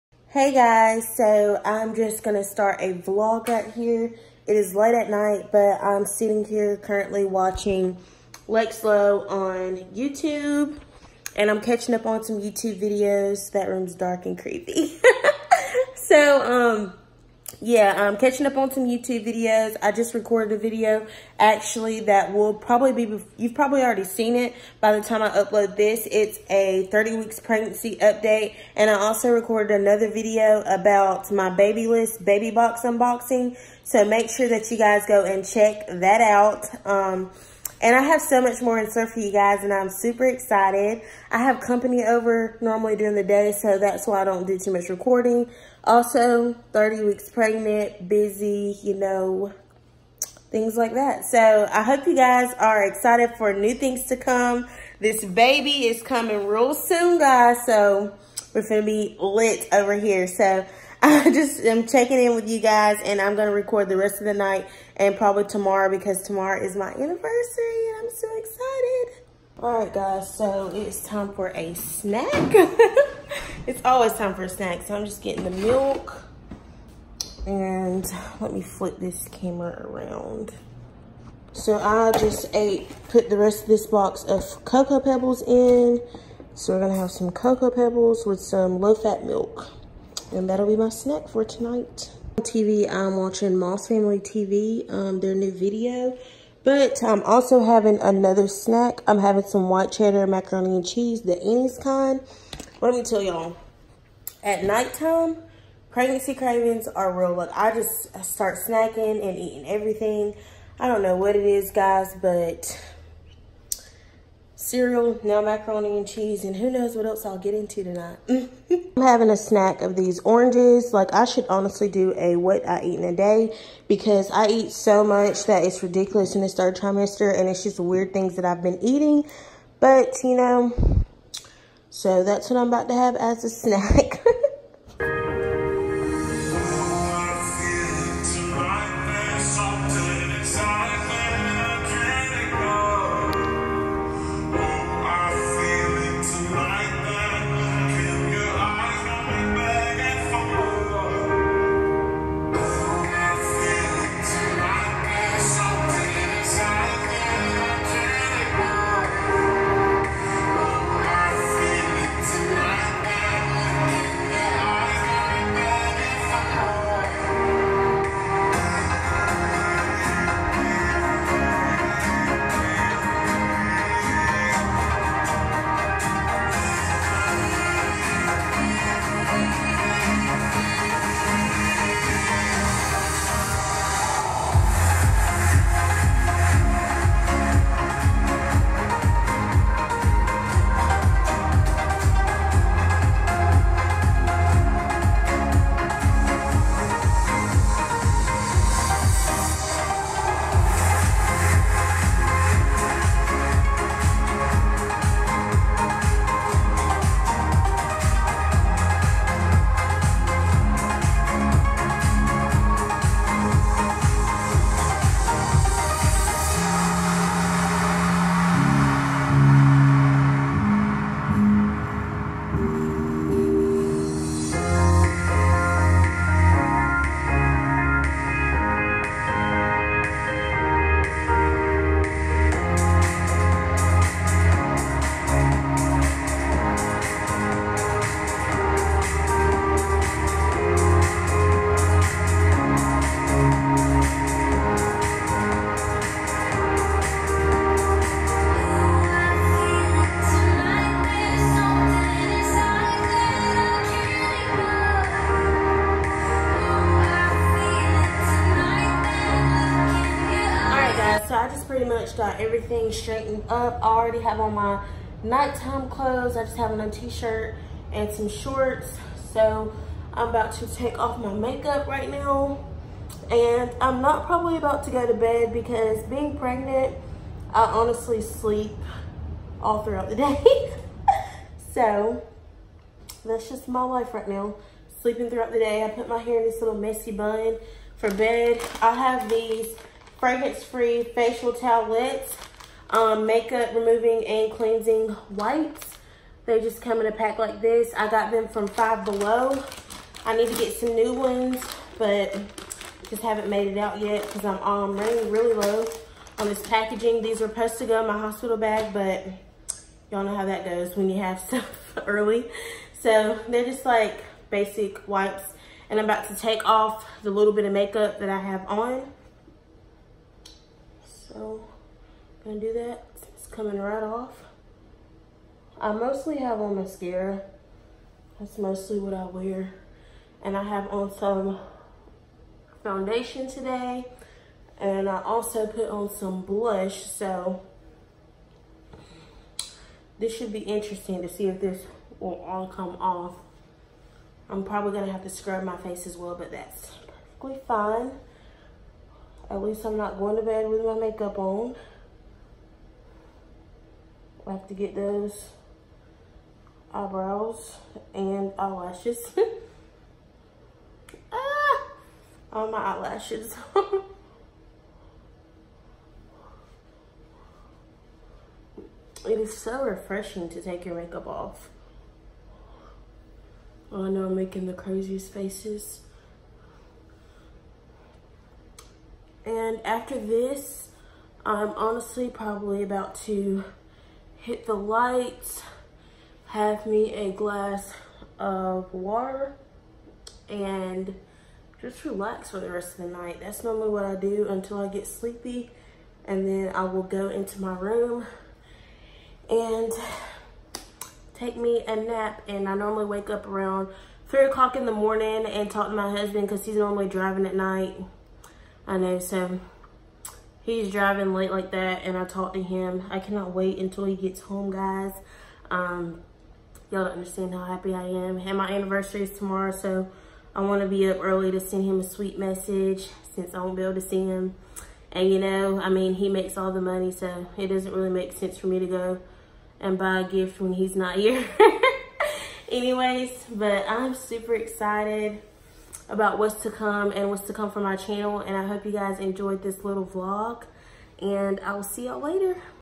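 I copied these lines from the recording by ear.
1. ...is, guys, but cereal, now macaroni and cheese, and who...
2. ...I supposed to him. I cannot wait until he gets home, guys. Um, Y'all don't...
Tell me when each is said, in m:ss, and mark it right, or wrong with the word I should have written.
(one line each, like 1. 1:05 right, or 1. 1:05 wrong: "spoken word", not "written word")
1. 1:51 right
2. 6:52 wrong: "talked", not "supposed".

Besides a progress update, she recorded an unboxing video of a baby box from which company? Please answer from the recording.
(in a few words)
Babylist.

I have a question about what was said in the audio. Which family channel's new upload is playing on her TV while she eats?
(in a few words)
Moss Family TV.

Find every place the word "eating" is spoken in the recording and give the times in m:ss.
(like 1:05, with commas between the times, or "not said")
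1:49, 2:08.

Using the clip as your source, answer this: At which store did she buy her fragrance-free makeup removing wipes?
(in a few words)
Five Below.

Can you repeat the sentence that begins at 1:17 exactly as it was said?
And let me flip this camera around.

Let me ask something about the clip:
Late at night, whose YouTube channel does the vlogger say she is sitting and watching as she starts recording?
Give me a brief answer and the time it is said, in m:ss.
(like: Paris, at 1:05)
Lex Lowe, at 0:08.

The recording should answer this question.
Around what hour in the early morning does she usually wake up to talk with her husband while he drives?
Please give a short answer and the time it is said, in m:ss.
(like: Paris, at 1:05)
3 o'clock, at 6:44.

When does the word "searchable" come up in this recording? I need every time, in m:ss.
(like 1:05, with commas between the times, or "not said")
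not said.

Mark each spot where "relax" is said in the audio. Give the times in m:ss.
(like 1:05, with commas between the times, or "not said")
6:32.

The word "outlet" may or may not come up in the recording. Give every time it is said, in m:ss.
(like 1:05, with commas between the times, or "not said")
not said.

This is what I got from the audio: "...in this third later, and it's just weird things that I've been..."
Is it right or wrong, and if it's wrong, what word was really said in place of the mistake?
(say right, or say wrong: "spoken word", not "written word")
wrong: "trimester", not "later".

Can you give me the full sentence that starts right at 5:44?
I'm probably gonna have to scrub my face as well, but that's perfectly fine.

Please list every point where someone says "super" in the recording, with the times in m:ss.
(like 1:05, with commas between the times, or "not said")
0:39, 7:14.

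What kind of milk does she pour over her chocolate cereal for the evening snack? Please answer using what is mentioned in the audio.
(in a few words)
Low-fat milk.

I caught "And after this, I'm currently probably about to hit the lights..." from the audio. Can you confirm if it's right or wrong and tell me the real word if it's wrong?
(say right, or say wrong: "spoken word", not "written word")
wrong: "honestly", not "currently".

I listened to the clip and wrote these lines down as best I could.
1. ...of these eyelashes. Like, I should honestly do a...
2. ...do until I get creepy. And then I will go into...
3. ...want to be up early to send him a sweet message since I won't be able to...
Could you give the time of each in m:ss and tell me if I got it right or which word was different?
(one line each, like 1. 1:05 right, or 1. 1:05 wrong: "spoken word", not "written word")
1. 1:59 wrong: "oranges", not "eyelashes"
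2. 6:34 wrong: "sleepy", not "creepy"
3. 7:00 right.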